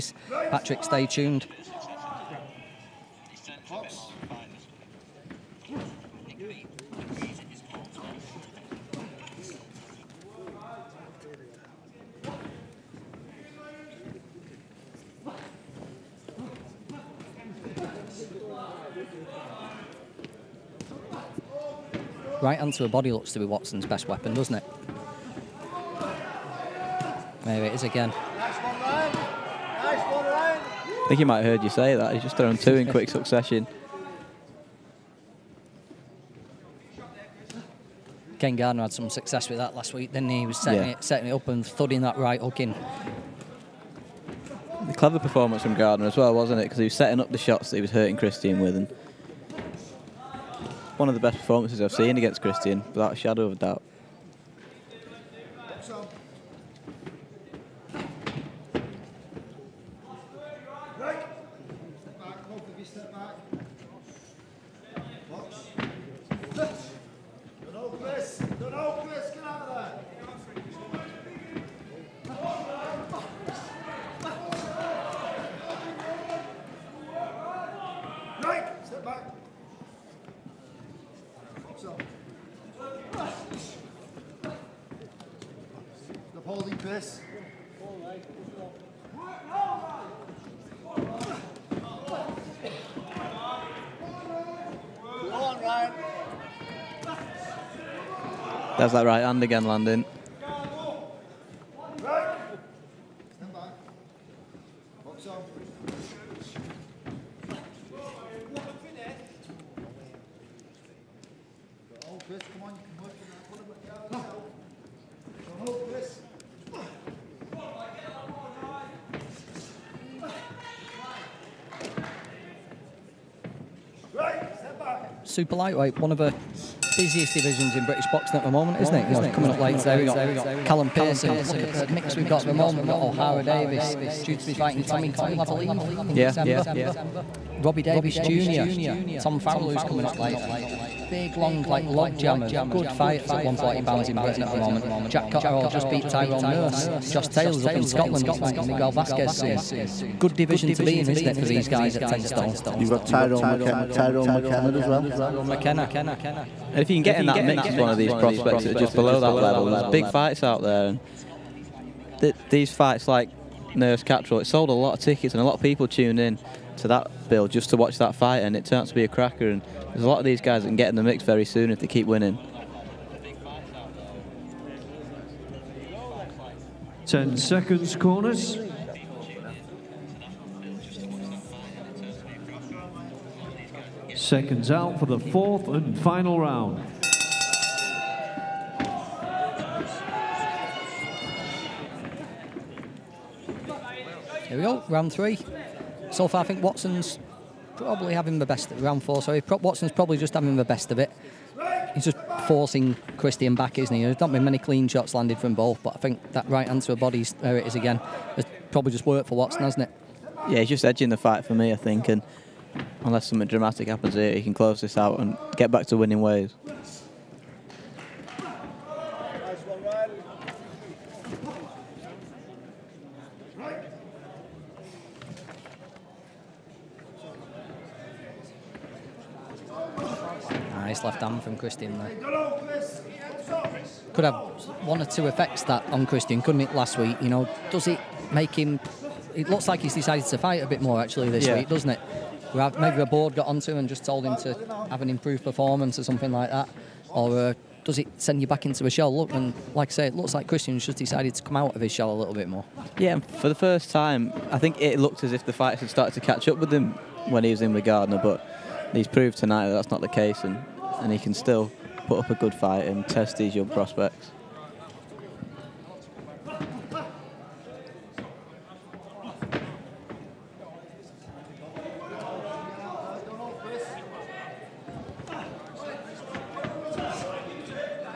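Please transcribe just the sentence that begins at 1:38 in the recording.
That's that right hand again landing.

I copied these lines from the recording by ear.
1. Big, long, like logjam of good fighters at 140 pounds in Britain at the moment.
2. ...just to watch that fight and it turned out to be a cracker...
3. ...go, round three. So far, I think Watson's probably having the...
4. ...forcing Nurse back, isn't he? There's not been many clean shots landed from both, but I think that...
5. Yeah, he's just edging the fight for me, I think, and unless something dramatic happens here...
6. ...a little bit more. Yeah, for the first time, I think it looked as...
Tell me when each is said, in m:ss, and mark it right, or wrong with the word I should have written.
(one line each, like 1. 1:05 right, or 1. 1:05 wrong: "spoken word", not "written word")
1. 2:21 right
2. 2:47 right
3. 3:14 right
4. 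3:22 wrong: "Kristian", not "Nurse"
5. 3:30 right
6. 4:12 right.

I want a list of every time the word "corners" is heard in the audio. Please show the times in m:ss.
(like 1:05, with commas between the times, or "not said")
2:57.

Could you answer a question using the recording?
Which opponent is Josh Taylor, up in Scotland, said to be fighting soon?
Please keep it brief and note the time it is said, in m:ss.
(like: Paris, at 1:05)
Miguel Vasquez, at 2:28.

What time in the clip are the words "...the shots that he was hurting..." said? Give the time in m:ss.
0:47.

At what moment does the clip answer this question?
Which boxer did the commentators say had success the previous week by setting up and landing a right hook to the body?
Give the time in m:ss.
0:38.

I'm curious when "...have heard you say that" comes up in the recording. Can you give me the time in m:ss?
0:31.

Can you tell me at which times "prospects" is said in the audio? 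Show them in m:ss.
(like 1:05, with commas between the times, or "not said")
2:38, 4:23.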